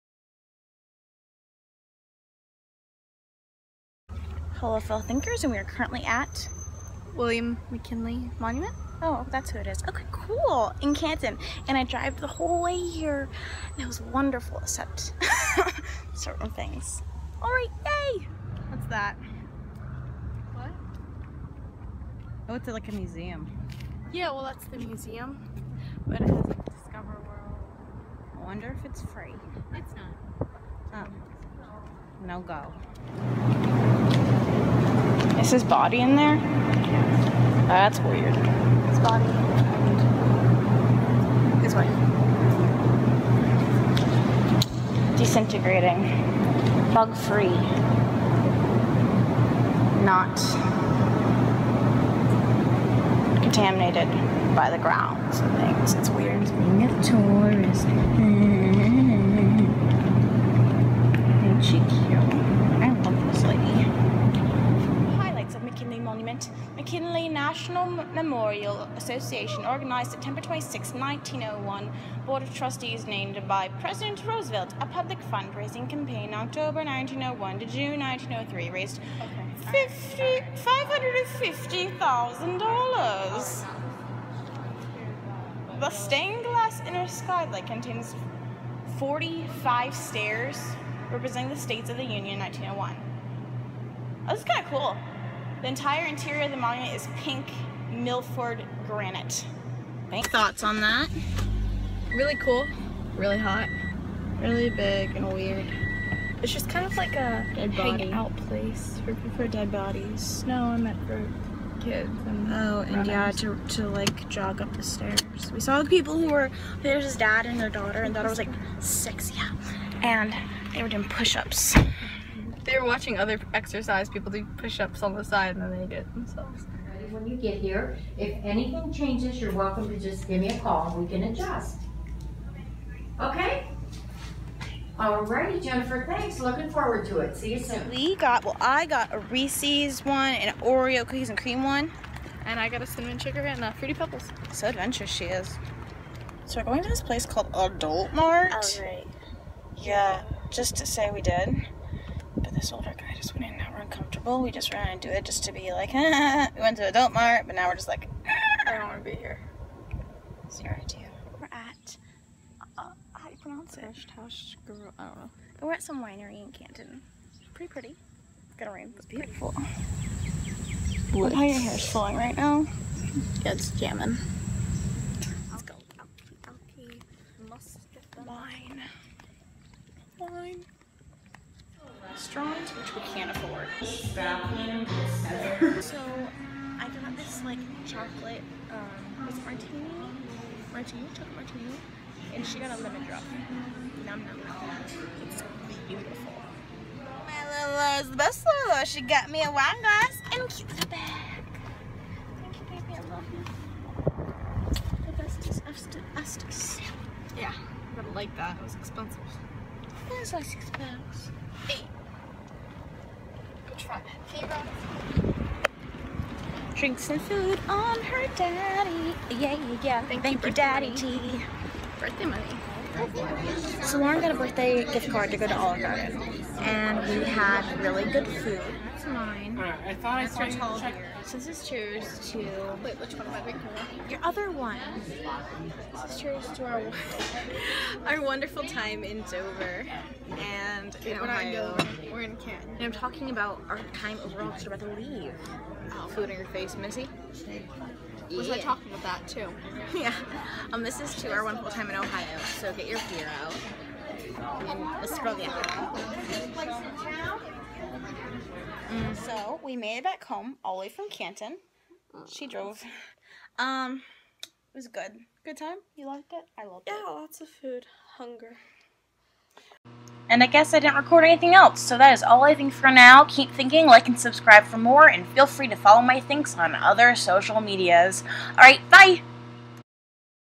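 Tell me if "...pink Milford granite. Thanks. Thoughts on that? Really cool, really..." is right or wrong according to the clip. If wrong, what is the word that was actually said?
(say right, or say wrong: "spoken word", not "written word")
right.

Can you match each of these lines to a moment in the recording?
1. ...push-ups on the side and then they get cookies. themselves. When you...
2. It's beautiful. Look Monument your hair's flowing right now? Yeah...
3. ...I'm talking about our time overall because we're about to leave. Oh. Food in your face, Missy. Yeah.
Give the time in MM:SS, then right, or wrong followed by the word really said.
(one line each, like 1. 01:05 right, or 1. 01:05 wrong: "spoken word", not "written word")
1. 02:04 wrong: "themselves", not "cookies"
2. 02:48 wrong: "How", not "Monument"
3. 04:02 right.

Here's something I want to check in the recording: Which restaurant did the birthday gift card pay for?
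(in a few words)
Olive Garden.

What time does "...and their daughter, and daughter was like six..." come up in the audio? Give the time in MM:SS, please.
01:57.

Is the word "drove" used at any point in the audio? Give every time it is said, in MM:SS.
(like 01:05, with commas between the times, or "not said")
00:11, 04:22.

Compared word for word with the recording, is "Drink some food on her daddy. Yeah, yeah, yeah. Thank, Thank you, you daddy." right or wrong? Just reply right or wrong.
right.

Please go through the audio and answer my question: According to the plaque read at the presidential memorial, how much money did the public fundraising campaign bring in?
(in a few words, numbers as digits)
$550,000.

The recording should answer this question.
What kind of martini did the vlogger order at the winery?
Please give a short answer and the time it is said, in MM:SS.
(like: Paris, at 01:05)
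chocolate martini, at 03:11.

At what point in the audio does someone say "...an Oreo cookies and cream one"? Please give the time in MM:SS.
02:20.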